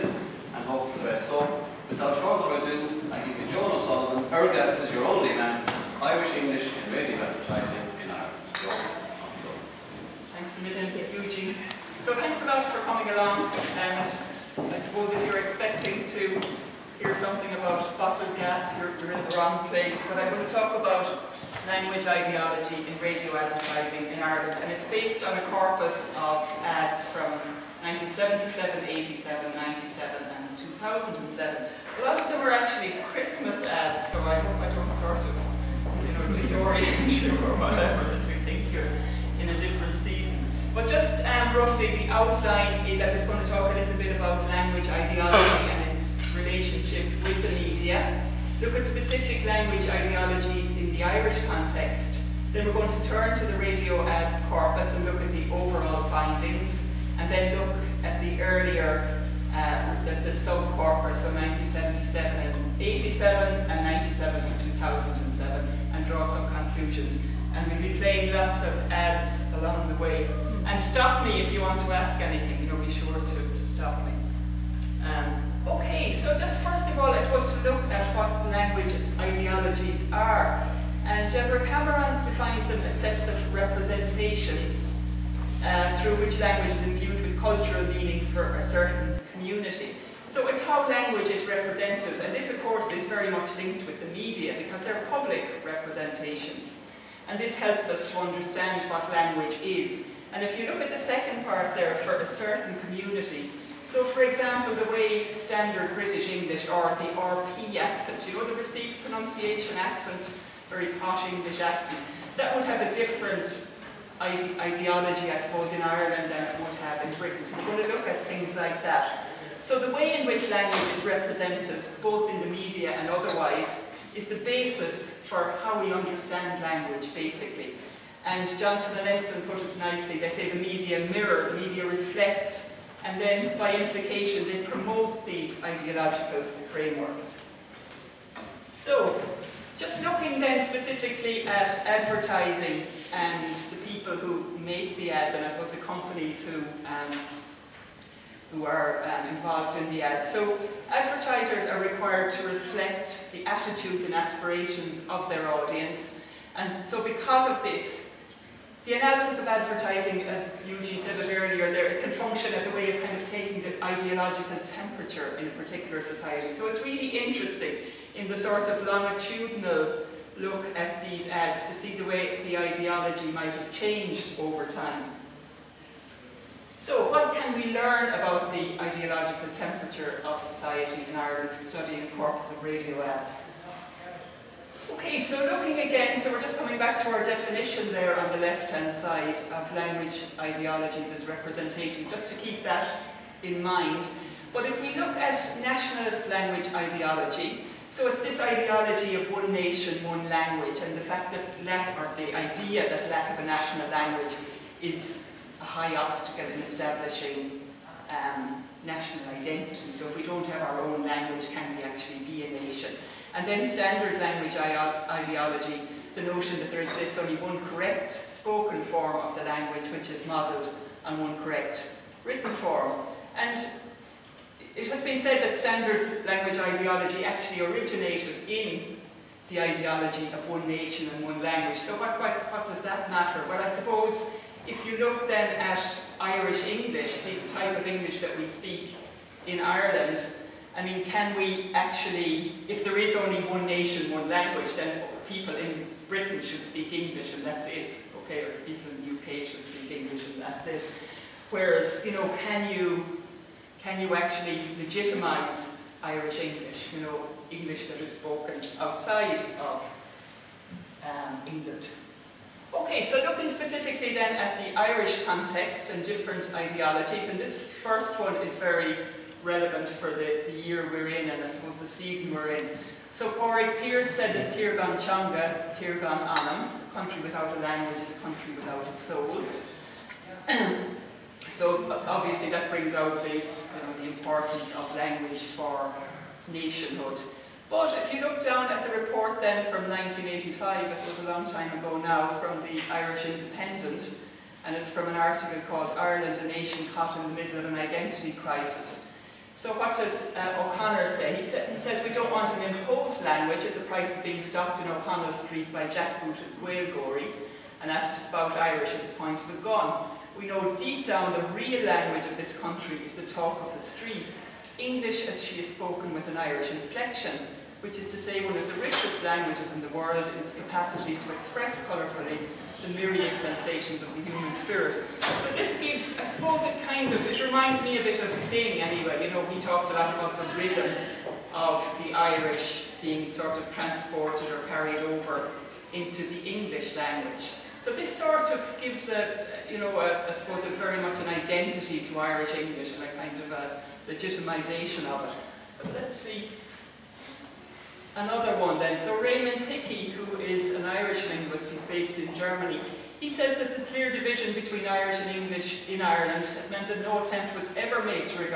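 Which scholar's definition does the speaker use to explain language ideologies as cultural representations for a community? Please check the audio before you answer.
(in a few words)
Deborah Cameron.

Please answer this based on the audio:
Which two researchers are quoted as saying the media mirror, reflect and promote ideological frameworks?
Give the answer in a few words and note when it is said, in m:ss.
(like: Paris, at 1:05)
Johnson and Ensslin, at 2:08.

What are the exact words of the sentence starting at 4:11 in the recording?
Whereas, you know, can you, can you actually legitimize Irish English, you know, English that is spoken outside of um, England?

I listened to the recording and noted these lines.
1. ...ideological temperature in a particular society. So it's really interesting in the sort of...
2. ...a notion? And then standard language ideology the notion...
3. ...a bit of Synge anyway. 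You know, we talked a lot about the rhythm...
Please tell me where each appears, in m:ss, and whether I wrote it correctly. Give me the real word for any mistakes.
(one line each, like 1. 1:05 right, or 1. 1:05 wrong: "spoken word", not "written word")
1. 2:43 right
2. 3:32 wrong: "nation", not "notion"
3. 5:27 right.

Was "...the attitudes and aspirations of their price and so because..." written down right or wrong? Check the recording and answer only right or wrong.
wrong.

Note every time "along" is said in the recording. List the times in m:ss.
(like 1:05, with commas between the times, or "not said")
0:13, 1:09.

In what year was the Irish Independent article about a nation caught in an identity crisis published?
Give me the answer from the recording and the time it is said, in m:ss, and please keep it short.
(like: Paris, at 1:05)
1985, at 4:49.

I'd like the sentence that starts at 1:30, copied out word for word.
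So it's how language is represented, and this of course is very much linked with the media because they're public representations.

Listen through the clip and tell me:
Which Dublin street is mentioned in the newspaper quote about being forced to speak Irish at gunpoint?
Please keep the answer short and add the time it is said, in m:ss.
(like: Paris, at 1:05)
O'Connell Street, at 5:04.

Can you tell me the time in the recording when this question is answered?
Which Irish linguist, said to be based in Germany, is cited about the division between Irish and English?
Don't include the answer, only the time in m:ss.
5:49.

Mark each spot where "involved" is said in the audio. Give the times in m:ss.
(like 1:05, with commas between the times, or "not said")
2:29.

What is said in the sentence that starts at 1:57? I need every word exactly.
So you want to look at things like that.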